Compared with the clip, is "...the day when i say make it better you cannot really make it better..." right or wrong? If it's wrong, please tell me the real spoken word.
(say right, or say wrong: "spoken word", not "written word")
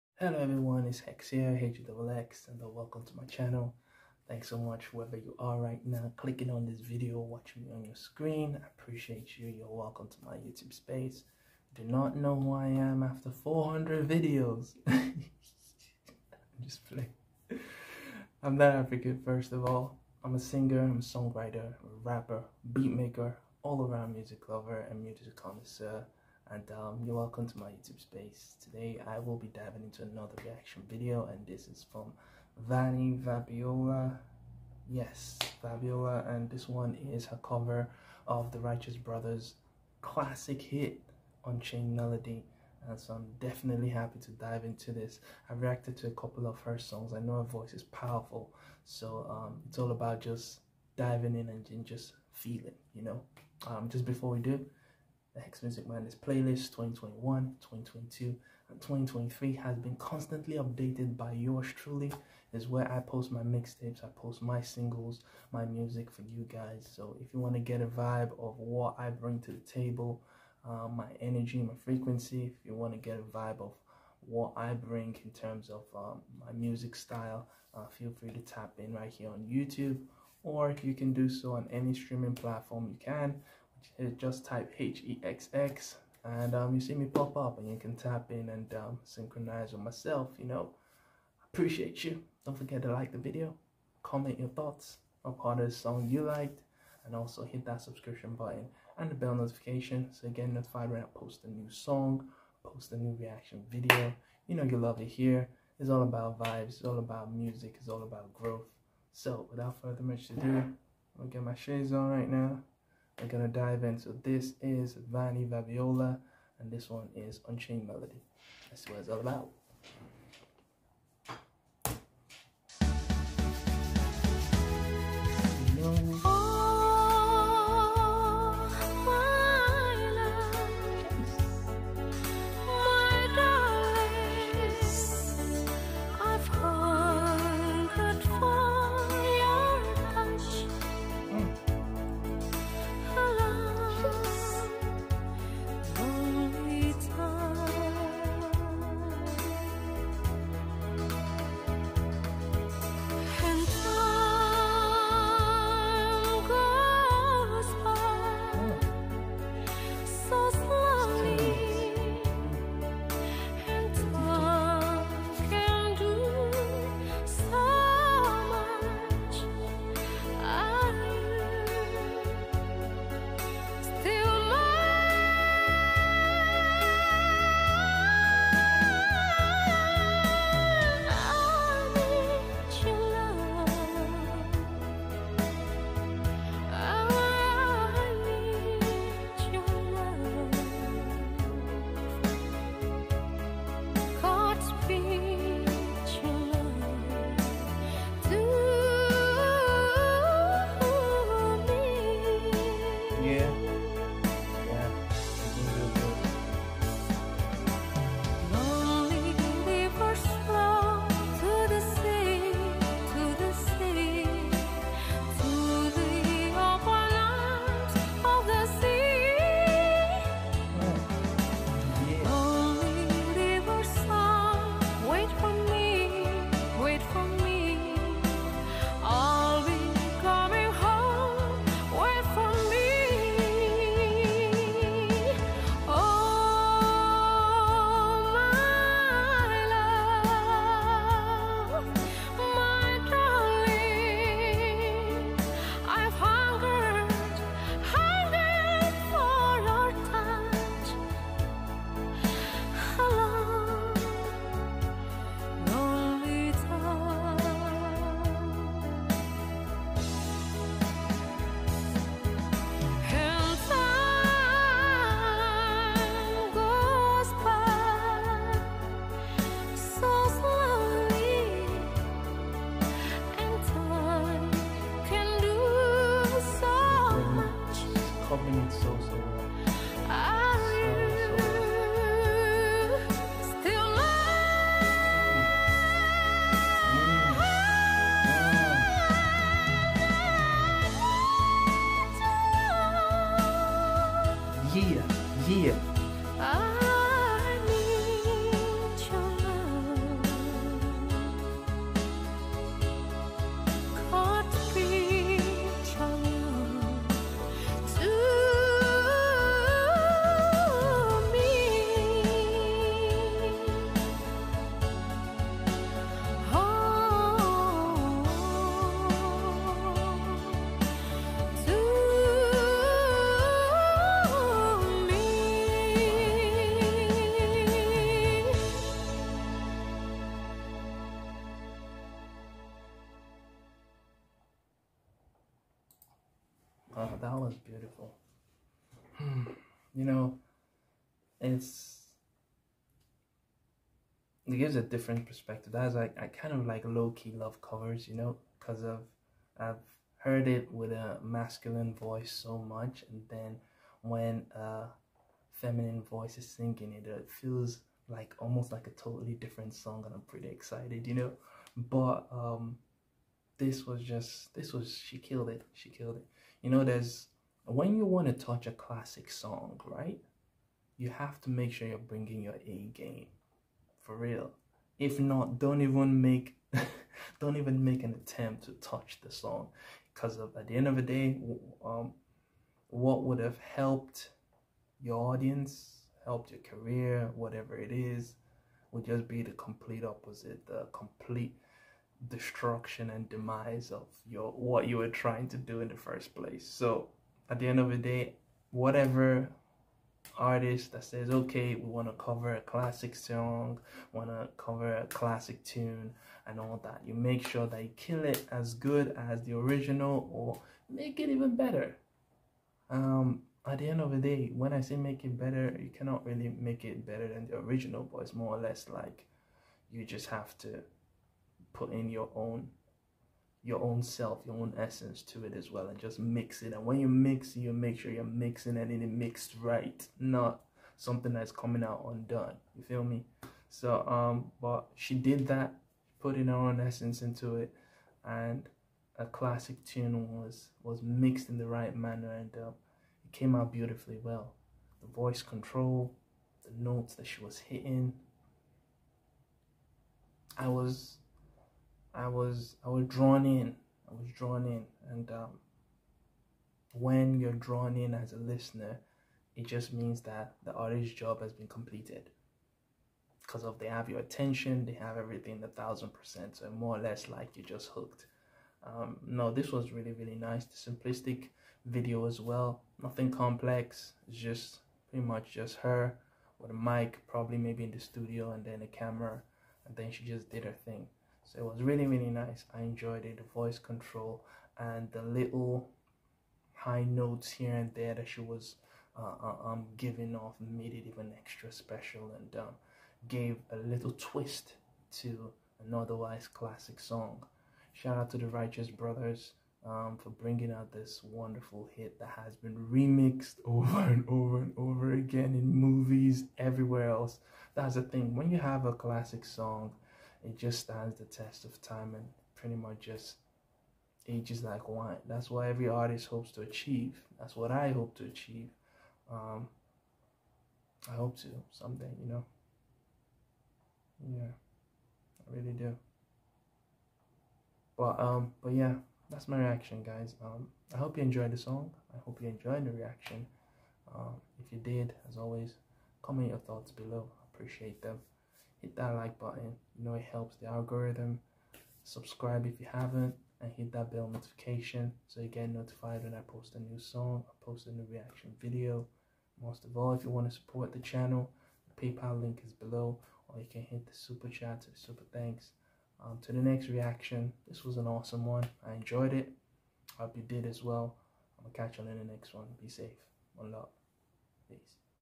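right.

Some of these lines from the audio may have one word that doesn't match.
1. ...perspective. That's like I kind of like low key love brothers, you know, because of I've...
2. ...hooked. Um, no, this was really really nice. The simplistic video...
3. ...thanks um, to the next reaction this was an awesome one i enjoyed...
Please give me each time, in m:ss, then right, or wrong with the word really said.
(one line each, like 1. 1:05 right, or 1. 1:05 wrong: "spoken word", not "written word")
1. 5:45 wrong: "covers", not "brothers"
2. 7:47 right
3. 9:15 right.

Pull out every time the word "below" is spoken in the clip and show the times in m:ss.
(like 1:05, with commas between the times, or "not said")
8:56, 9:12.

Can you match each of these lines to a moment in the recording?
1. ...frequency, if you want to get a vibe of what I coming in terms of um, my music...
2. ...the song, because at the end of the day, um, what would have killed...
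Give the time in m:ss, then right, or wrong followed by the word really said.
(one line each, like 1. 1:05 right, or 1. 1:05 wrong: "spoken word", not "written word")
1. 1:11 wrong: "bring", not "coming"
2. 6:19 wrong: "helped", not "killed".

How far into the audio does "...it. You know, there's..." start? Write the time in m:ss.
6:06.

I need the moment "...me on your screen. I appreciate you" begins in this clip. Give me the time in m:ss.
0:07.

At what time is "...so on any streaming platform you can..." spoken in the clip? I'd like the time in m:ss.
1:21.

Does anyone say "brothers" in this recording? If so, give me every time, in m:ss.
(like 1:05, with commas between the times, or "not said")
0:38, 8:18.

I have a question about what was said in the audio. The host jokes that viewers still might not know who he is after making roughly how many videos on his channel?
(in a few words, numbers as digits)
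400.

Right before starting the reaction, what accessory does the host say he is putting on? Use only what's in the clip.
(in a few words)
Shades.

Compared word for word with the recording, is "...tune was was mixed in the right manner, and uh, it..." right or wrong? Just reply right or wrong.
right.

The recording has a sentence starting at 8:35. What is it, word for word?
That's what every artist hopes to achieve.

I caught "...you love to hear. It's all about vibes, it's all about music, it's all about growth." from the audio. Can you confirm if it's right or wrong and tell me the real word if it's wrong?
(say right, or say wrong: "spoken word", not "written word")
right.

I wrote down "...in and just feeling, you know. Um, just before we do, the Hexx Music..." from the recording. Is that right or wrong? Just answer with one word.
right.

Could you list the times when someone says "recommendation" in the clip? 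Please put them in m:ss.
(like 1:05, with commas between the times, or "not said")
not said.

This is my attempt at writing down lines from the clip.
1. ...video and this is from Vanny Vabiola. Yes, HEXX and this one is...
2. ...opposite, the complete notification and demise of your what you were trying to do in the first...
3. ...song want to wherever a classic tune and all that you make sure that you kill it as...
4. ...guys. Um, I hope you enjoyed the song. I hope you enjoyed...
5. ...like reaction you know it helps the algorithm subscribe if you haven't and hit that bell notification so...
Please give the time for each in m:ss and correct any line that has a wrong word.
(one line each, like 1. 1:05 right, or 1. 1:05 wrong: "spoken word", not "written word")
1. 0:30 wrong: "Vabiola", not "HEXX"
2. 6:30 wrong: "destruction", not "notification"
3. 6:43 wrong: "cover", not "wherever"
4. 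8:50 right
5. 8:59 wrong: "button", not "reaction".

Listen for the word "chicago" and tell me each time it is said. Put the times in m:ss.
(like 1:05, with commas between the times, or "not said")
not said.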